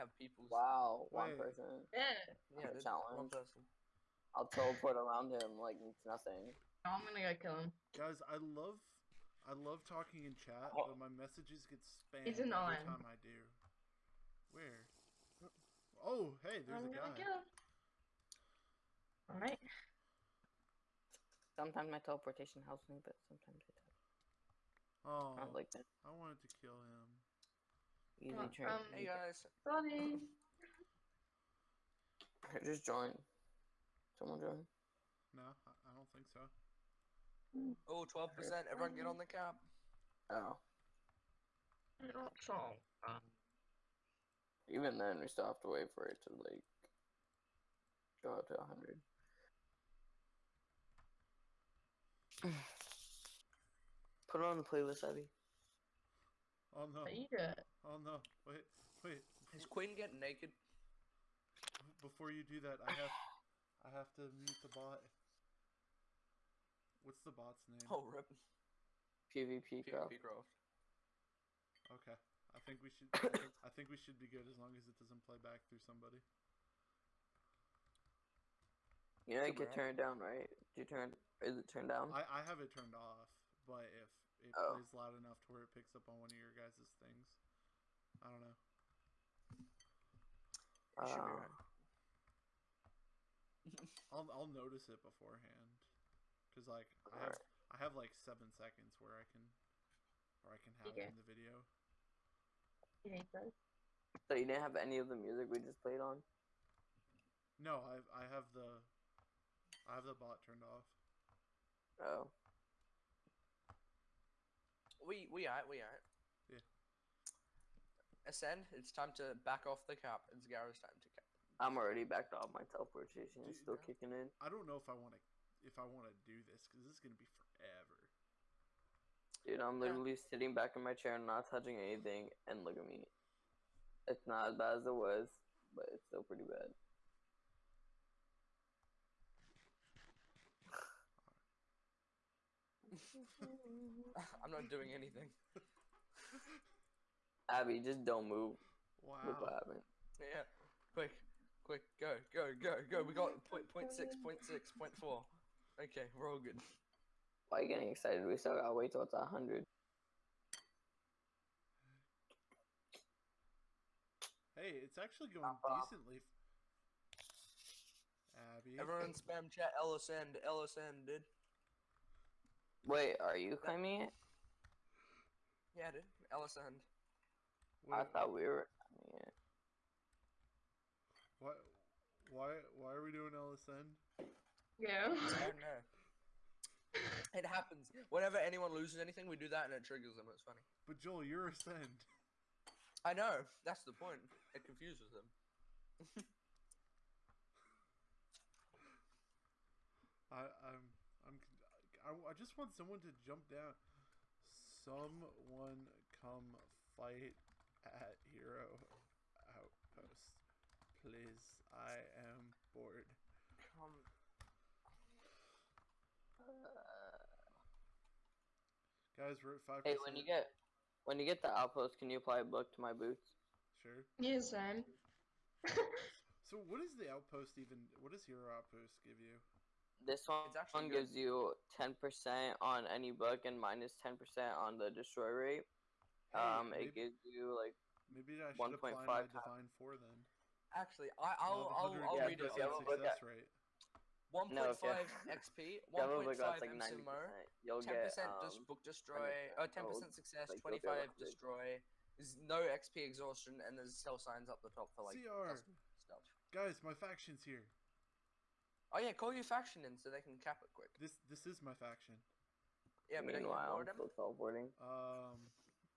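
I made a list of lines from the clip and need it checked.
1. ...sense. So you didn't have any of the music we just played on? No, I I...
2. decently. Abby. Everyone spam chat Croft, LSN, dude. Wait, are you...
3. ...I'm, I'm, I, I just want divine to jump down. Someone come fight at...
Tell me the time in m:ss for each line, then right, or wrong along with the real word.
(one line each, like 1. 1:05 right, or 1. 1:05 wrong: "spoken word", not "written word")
1. 1:43 right
2. 2:45 wrong: "LSN", not "Croft"
3. 3:20 wrong: "someone", not "divine".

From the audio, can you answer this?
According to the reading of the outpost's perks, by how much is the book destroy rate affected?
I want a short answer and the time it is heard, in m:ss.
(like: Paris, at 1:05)
25, at 4:10.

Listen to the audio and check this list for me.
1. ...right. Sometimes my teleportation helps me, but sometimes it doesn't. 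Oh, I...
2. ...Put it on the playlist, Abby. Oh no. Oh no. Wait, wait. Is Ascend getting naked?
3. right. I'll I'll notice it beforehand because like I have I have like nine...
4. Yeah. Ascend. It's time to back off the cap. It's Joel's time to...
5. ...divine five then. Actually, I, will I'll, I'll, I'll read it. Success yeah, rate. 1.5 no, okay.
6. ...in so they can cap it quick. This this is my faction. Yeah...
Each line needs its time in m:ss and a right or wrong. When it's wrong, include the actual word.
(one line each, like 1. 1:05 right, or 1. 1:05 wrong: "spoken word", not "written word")
1. 0:19 right
2. 0:54 wrong: "Quinn", not "Ascend"
3. 1:31 wrong: "seven", not "nine"
4. 1:56 wrong: "Garo", not "Joel"
5. 3:59 wrong: "four", not "five"
6. 4:19 right.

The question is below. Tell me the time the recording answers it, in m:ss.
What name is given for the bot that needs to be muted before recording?
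1:09.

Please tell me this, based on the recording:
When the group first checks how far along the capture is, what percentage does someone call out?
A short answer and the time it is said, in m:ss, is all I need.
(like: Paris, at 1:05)
12%, at 0:38.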